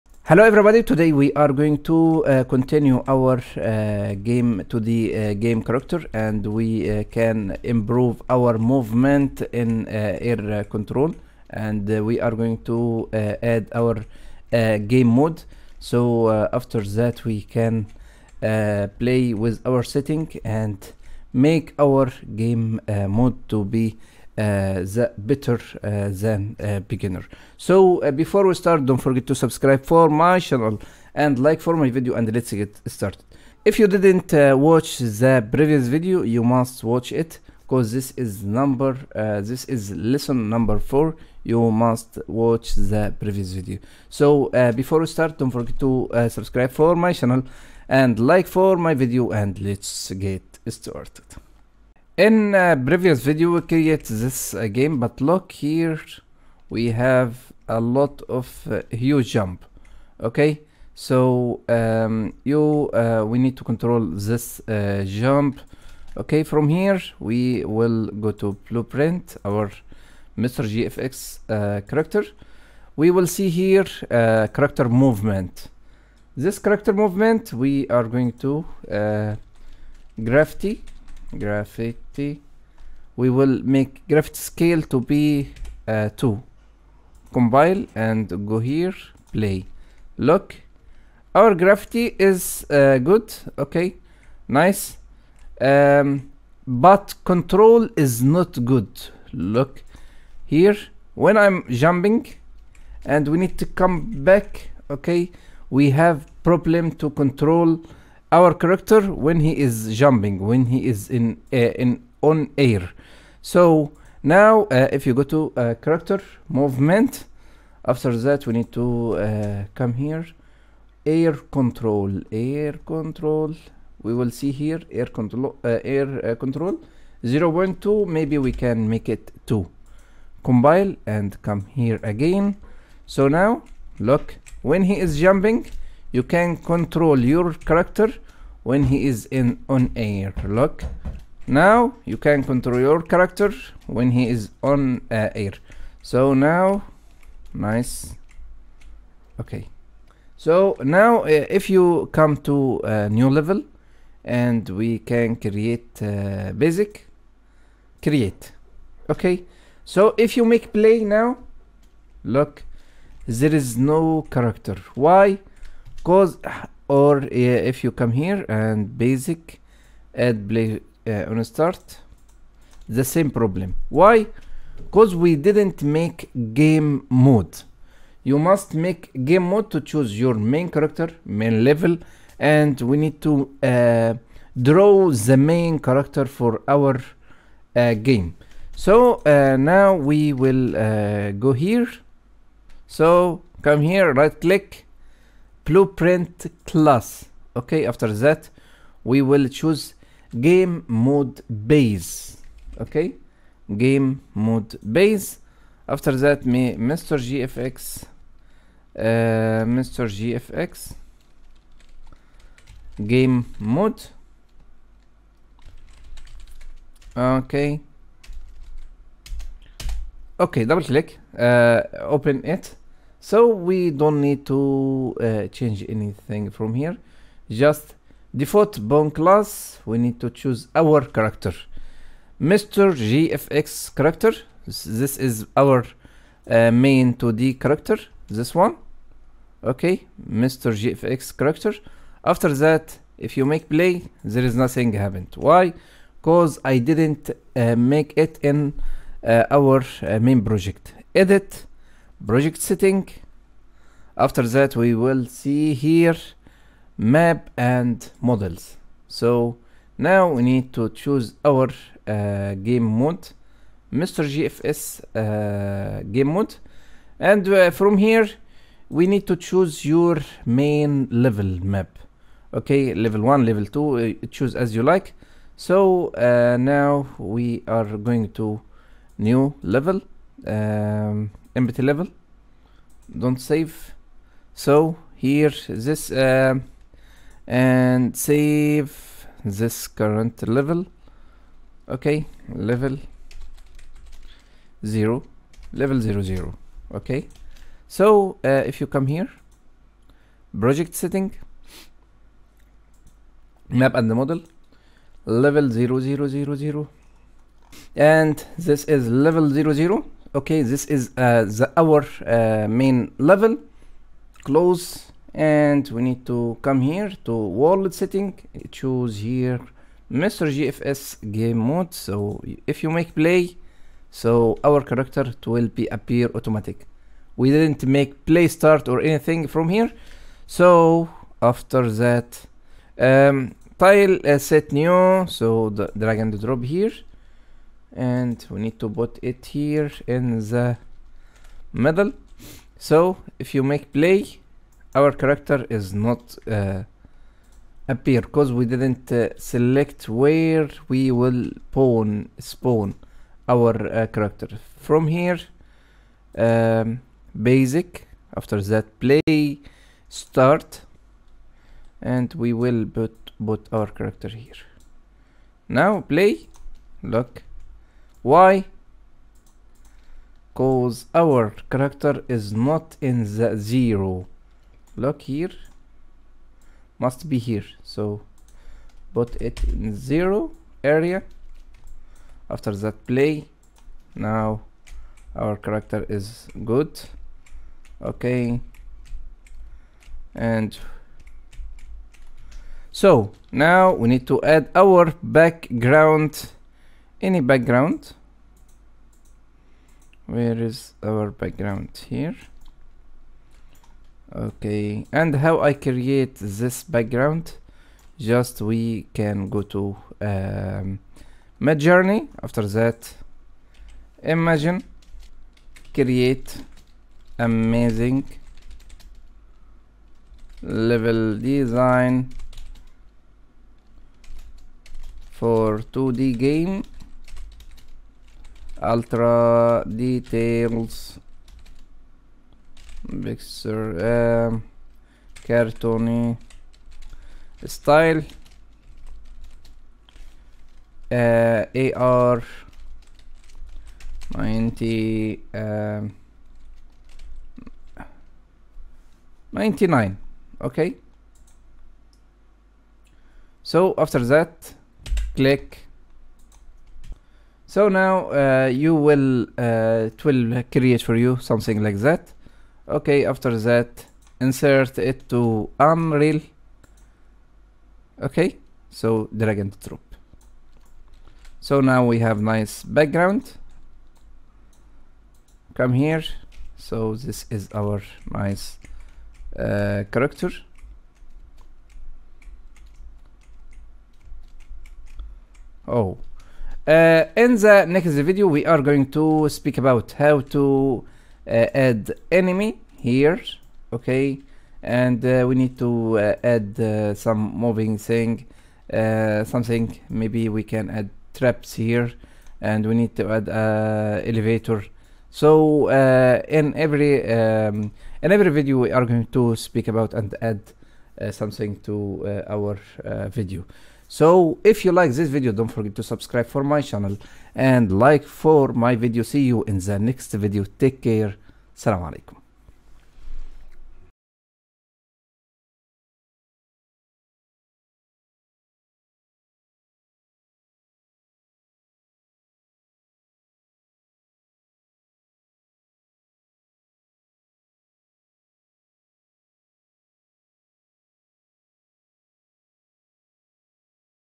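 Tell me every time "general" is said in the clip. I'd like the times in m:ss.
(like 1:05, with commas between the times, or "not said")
not said.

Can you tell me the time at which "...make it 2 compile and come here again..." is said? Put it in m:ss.
2:08.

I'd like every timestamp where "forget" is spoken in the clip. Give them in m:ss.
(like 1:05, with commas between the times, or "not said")
0:28, 0:45, 8:35.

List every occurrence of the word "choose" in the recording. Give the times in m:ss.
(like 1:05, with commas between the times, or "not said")
2:59, 3:19, 3:50, 4:20, 4:29, 4:34, 5:18.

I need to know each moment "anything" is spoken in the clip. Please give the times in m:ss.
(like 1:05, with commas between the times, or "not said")
3:45, 5:29.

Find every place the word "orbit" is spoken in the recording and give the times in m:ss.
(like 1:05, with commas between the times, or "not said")
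not said.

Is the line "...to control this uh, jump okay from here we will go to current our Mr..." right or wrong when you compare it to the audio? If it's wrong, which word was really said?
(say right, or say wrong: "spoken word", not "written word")
wrong: "blueprint", not "current".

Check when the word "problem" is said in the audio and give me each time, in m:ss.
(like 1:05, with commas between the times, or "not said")
1:46, 2:53.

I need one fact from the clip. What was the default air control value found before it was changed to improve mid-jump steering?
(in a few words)
0.2.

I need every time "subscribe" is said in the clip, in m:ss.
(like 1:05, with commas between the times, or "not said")
0:29, 0:46, 8:36.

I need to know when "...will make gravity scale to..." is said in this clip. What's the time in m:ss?
1:23.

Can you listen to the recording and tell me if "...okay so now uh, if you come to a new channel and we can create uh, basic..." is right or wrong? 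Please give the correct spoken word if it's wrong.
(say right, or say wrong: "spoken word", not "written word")
wrong: "level", not "channel".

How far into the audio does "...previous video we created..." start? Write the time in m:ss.
0:52.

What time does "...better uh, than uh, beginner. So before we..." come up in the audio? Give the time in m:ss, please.
0:25.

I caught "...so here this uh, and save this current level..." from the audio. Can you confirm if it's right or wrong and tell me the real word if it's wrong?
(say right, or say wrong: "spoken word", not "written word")
right.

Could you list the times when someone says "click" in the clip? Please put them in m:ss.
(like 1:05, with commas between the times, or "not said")
3:14, 3:40, 7:35.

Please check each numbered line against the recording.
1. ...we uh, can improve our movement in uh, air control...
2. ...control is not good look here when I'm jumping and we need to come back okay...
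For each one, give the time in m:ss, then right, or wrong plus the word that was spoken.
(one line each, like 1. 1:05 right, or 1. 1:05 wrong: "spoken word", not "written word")
1. 0:06 right
2. 1:37 right.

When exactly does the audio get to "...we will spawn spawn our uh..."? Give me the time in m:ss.
5:50.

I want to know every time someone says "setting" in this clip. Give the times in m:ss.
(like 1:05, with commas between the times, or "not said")
0:19, 4:12, 5:00, 5:17.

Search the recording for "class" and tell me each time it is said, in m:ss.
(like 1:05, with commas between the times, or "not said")
3:16, 3:49.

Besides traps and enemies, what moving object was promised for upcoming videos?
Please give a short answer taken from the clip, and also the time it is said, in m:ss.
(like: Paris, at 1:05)
Elevator, at 8:24.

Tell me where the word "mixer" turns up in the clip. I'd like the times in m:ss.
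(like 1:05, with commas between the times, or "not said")
7:13.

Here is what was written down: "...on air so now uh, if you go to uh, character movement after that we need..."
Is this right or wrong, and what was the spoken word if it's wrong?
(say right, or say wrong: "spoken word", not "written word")
right.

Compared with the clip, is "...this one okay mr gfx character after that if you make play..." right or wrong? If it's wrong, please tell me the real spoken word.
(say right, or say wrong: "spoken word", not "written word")
right.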